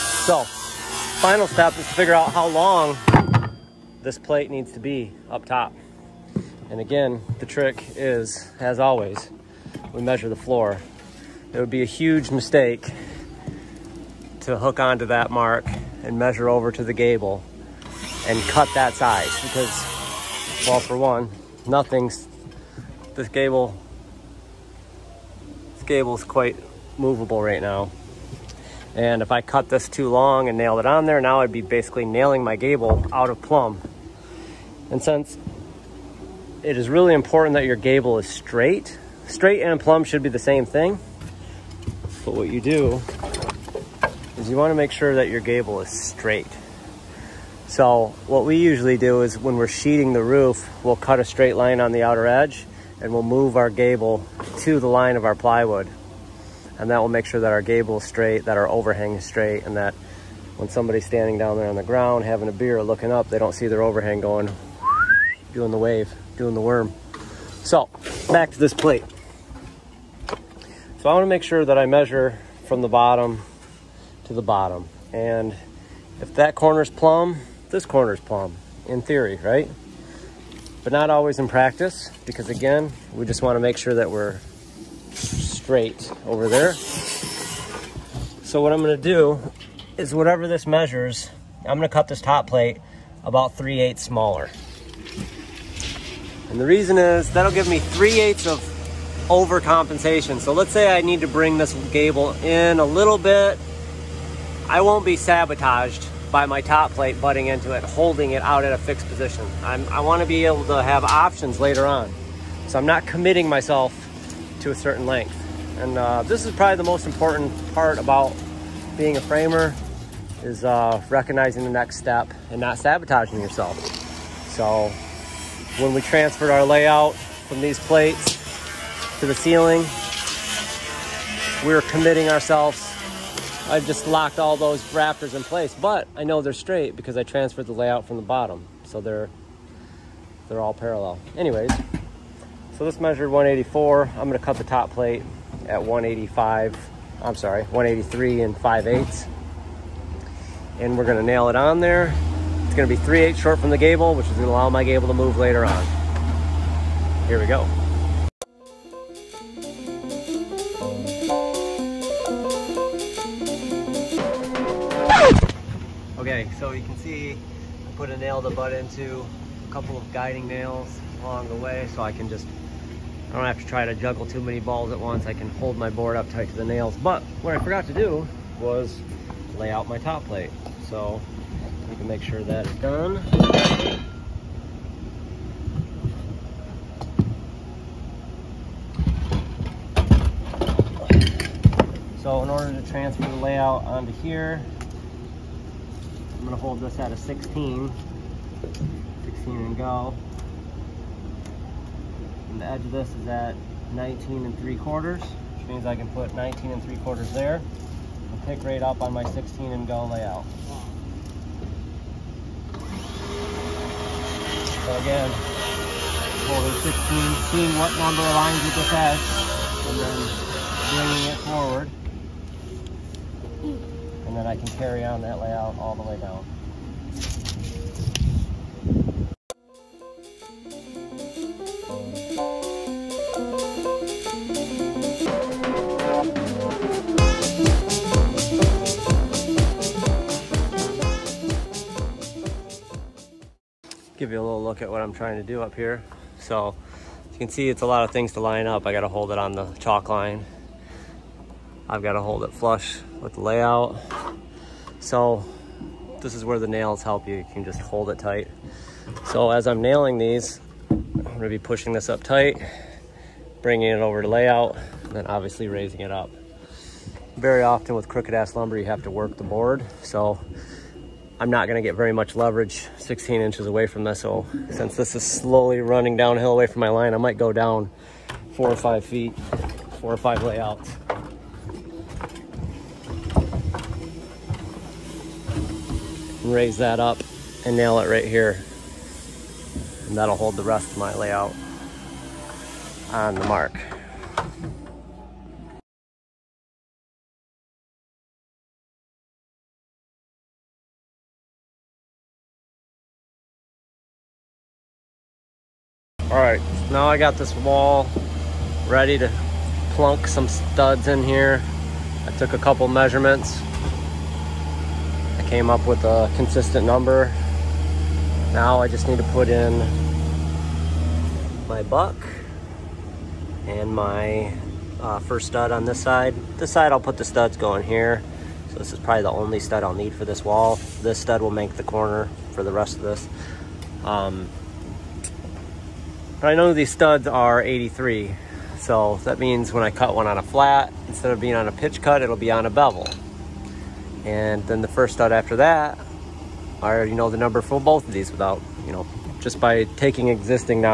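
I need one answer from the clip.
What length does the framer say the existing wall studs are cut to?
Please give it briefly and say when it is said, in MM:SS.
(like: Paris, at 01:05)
83, at 05:37.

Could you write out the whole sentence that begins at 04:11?
I've got to hold it flush with the layout.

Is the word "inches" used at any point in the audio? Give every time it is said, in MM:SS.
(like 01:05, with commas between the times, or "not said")
04:33.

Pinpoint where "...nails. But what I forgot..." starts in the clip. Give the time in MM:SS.
02:56.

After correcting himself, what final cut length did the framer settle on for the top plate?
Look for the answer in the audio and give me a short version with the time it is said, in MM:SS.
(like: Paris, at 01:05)
183 5/8, at 02:27.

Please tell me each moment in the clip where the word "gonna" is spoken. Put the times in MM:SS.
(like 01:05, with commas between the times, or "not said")
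02:24, 02:31, 03:16, 04:31.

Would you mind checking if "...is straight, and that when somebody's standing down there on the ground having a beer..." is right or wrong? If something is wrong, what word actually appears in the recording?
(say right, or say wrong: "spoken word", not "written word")
right.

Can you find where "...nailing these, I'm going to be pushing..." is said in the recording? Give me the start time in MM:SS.
04:19.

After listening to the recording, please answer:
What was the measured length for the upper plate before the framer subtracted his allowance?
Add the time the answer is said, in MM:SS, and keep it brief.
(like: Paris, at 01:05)
184, at 02:23.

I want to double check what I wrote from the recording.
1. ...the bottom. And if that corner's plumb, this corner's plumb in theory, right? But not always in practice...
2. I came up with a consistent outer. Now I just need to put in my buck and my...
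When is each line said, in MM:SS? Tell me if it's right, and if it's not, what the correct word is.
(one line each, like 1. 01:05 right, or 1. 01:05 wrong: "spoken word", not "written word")
1. 01:14 right
2. 05:15 wrong: "number", not "outer".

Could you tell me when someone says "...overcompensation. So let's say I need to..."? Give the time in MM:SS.
01:39.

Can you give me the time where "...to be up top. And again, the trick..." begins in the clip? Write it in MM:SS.
00:04.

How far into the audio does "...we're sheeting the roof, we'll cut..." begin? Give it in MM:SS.
00:49.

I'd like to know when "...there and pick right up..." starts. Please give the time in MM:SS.
03:27.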